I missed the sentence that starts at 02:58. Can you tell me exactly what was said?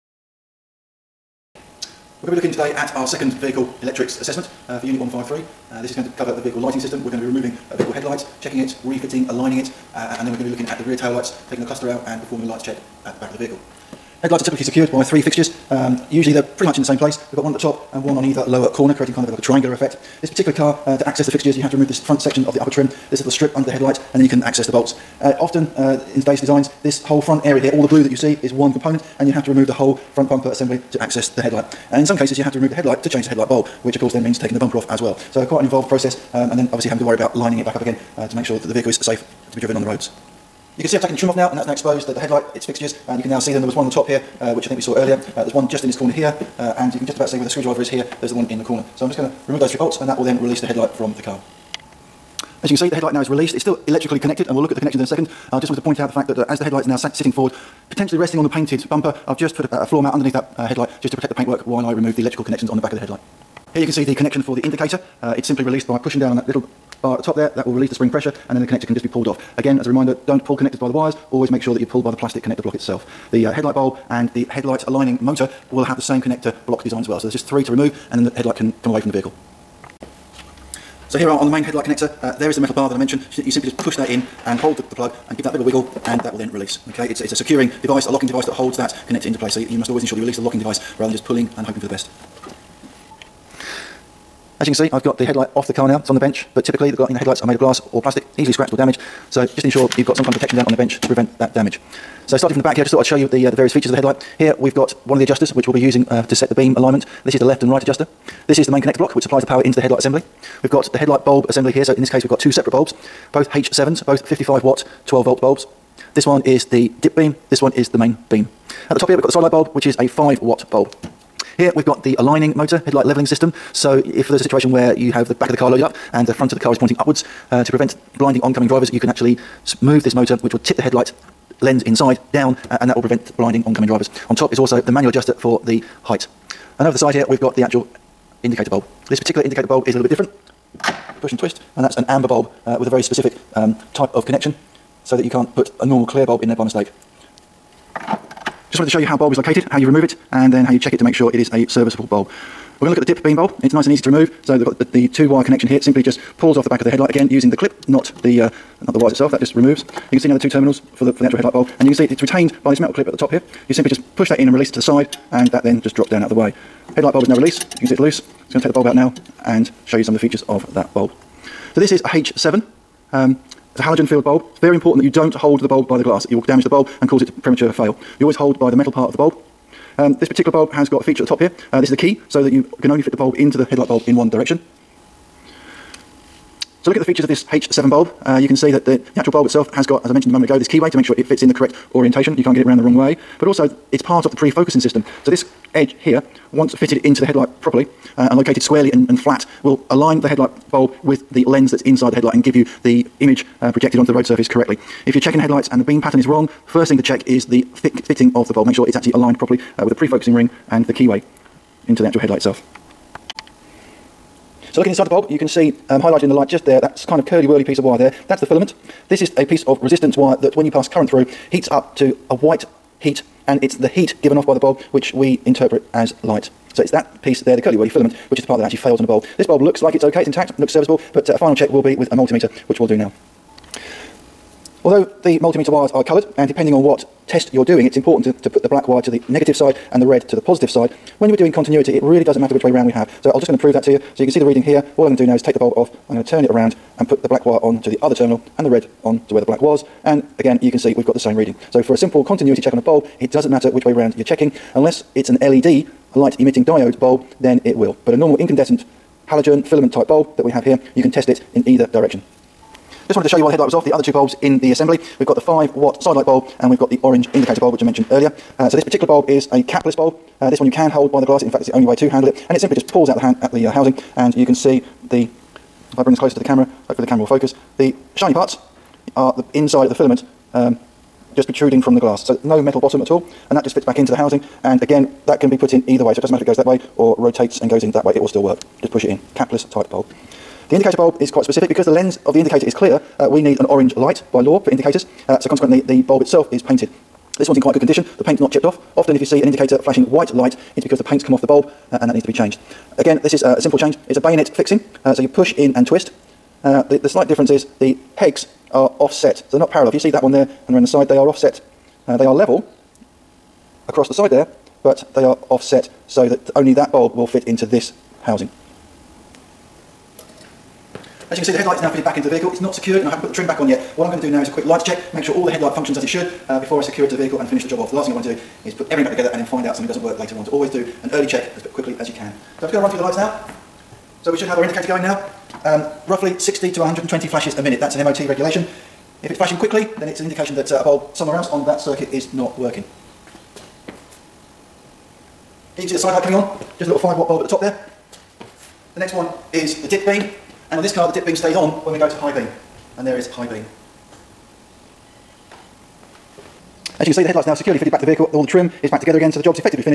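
You always hold by the metal part of the bulb um, this particular bulb has got a feature at the top here.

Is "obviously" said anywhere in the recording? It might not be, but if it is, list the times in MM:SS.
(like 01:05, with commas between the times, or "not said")
00:36.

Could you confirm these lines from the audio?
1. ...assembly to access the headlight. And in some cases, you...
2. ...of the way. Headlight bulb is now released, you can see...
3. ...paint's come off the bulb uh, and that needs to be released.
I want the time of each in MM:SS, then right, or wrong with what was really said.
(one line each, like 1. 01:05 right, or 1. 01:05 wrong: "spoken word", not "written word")
1. 00:30 right
2. 02:46 right
3. 05:01 wrong: "changed", not "released".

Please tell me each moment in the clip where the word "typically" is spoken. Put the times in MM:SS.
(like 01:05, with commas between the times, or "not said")
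00:14, 01:36.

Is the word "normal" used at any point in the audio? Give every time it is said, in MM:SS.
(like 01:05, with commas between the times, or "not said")
02:25, 04:18.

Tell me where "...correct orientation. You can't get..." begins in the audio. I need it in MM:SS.
03:11.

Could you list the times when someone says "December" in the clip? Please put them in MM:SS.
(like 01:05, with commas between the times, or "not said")
not said.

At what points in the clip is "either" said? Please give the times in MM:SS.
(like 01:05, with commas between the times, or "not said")
00:18, 04:21, 04:45.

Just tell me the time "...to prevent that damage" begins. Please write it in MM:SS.
01:41.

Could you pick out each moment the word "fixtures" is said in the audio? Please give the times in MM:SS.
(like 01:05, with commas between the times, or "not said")
00:15, 00:21, 00:42.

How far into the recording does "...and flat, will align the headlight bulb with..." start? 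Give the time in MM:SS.
03:19.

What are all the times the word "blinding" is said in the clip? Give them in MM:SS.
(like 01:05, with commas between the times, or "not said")
02:08, 02:13.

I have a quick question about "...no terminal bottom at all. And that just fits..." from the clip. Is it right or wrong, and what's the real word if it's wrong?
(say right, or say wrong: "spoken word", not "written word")
wrong: "metal", not "terminal".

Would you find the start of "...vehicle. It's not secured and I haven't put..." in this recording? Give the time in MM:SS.
05:22.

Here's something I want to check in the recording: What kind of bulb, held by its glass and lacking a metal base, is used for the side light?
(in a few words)
Capless bulb.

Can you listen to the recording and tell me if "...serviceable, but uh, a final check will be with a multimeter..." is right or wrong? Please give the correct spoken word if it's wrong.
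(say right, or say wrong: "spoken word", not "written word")
right.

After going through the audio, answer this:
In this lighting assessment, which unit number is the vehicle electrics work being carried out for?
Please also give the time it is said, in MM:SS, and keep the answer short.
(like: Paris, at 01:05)
Unit 153, at 00:04.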